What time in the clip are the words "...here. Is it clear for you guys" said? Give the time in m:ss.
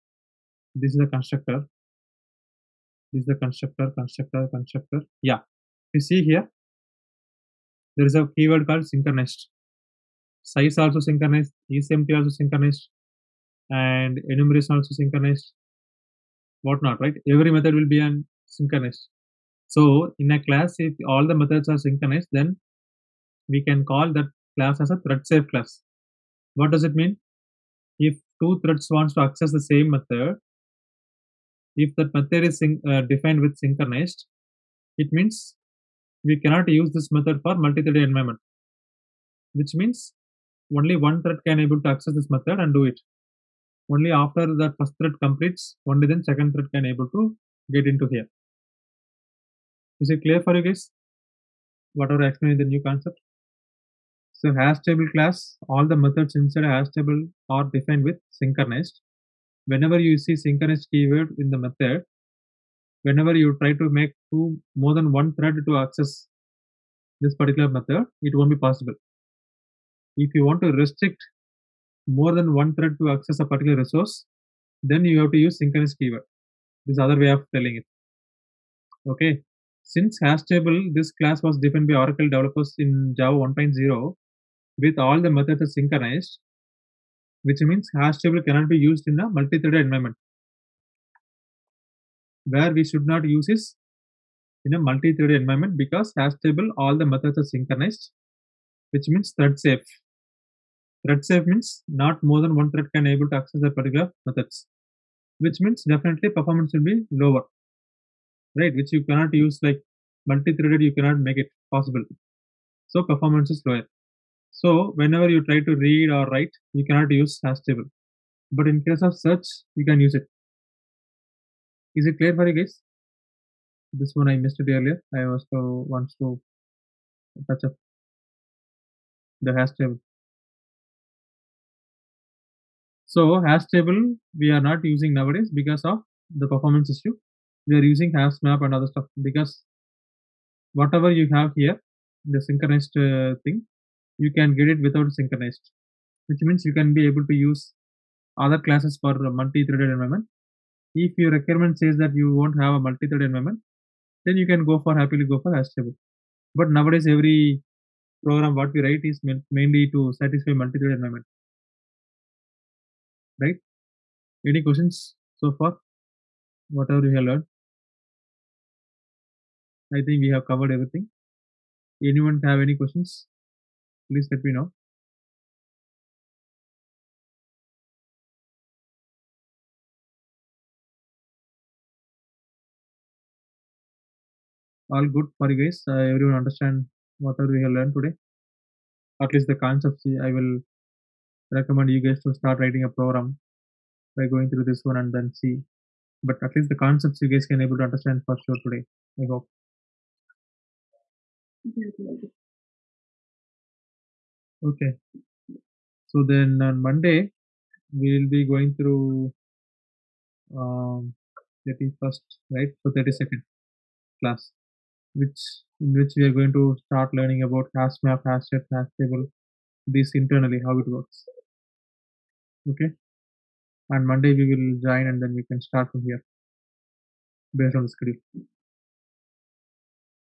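0:48.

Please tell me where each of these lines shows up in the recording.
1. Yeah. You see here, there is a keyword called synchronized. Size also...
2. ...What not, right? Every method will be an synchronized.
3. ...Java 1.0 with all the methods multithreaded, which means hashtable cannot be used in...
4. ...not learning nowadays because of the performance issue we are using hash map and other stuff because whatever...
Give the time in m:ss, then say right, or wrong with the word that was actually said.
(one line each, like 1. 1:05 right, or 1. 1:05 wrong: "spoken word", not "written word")
1. 0:05 right
2. 0:16 right
3. 1:23 wrong: "synchronized", not "multithreaded"
4. 2:14 wrong: "using", not "learning".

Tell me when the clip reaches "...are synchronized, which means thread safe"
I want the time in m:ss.
1:37.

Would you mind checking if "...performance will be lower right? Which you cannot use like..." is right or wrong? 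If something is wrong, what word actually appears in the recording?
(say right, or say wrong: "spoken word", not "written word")
right.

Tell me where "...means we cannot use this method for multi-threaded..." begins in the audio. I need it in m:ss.
0:35.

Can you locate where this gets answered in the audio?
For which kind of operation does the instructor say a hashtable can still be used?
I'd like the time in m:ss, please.
1:59.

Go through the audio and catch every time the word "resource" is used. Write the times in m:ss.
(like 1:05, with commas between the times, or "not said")
1:13.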